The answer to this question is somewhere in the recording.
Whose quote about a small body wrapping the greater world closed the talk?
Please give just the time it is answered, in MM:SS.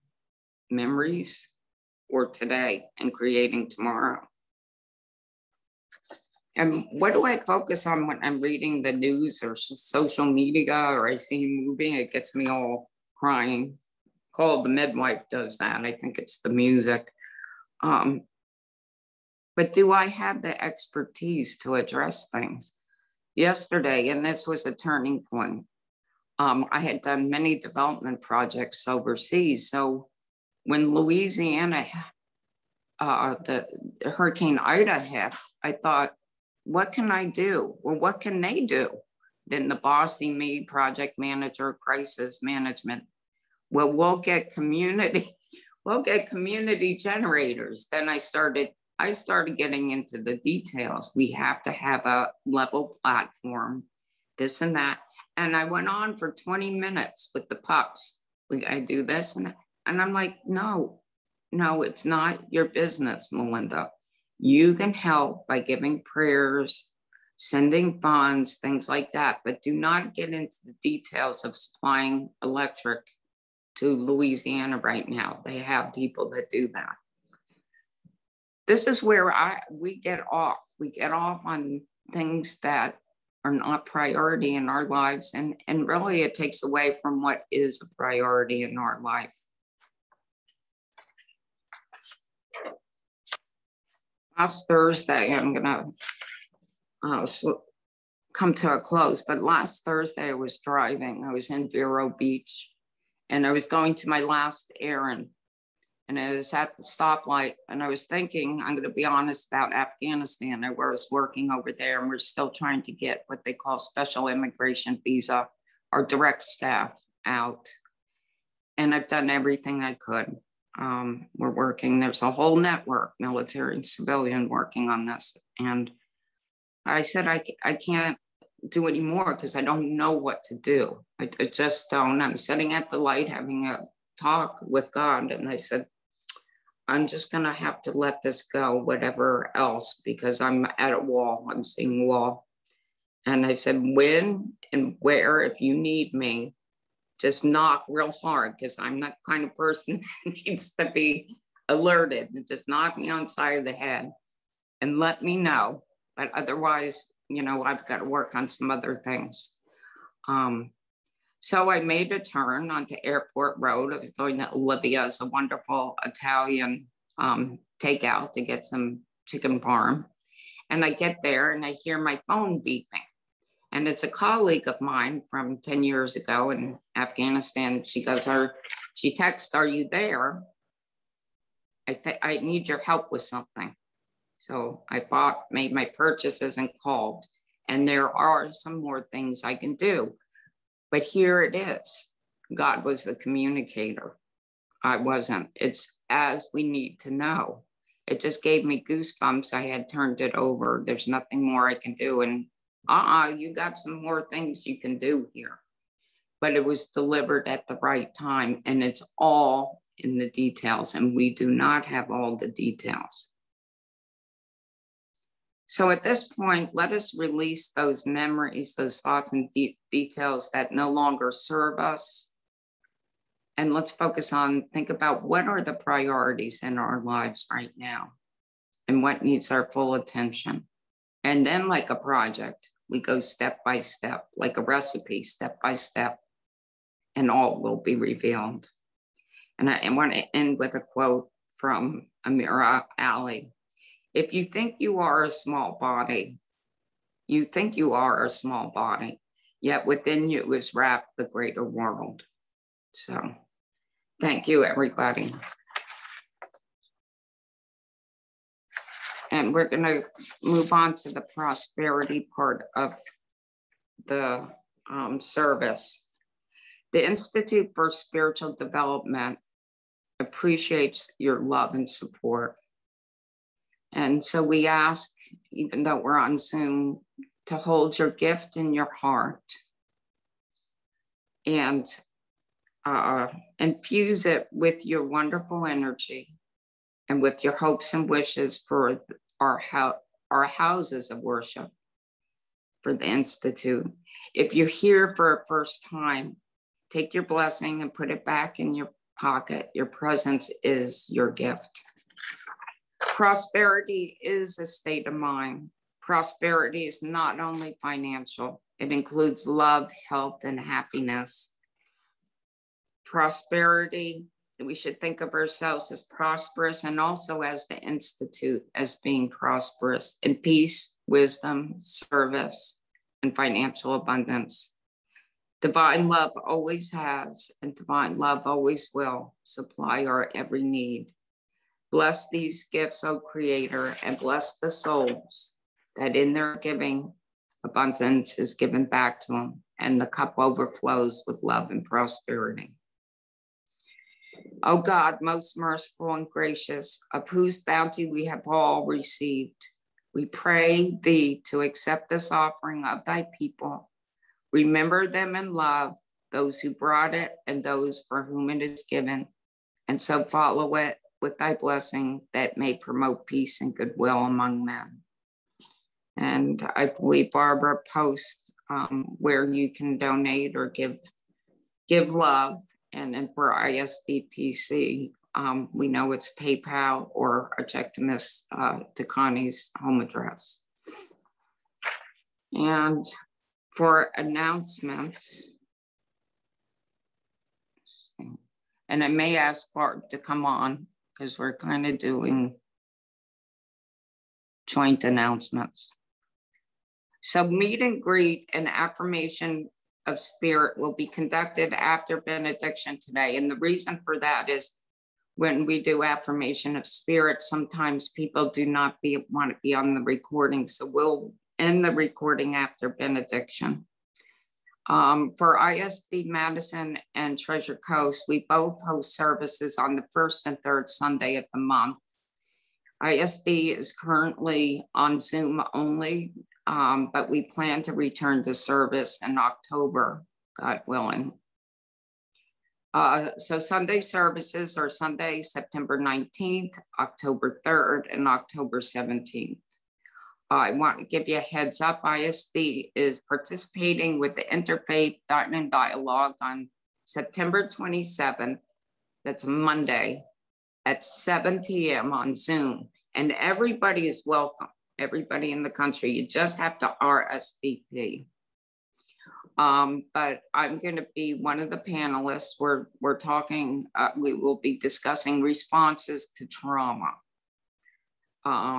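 04:02.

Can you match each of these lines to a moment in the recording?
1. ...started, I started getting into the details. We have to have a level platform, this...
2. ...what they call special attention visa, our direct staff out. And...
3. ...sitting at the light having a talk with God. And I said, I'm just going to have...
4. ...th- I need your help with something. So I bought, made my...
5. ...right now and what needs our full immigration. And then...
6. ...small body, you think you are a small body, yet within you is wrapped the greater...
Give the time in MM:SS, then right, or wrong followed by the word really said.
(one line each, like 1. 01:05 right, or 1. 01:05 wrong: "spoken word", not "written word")
1. 00:48 right
2. 01:53 wrong: "immigration", not "attention"
3. 02:12 right
4. 03:01 right
5. 03:47 wrong: "attention", not "immigration"
6. 04:05 right.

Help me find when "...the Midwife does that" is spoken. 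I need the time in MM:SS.
00:14.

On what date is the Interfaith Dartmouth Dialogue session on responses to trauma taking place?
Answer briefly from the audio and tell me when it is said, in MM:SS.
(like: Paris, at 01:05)
September 27th, at 07:27.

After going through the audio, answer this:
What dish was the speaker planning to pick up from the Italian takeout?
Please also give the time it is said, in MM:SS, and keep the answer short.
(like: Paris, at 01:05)
chicken parm, at 02:49.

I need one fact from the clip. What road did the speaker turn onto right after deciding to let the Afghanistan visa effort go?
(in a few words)
Airport Road.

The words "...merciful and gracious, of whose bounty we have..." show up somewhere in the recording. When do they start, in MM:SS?
05:45.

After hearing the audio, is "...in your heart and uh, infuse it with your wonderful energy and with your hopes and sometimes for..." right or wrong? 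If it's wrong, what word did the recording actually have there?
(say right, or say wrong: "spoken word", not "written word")
wrong: "wishes", not "sometimes".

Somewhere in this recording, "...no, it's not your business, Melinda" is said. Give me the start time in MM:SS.
01:01.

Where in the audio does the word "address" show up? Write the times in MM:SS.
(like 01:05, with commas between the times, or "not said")
00:21, 06:20.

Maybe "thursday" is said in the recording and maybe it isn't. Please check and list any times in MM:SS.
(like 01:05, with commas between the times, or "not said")
01:34, 01:39.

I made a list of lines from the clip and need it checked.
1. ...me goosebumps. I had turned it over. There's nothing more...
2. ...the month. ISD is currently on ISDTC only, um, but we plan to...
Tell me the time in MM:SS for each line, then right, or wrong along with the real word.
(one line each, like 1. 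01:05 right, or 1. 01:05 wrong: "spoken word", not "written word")
1. 03:18 right
2. 07:01 wrong: "Zoom", not "ISDTC".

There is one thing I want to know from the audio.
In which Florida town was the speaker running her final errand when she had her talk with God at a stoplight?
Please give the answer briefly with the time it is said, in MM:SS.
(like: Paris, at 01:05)
Vero Beach, at 01:41.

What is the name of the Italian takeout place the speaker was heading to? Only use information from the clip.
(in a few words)
Olivia's.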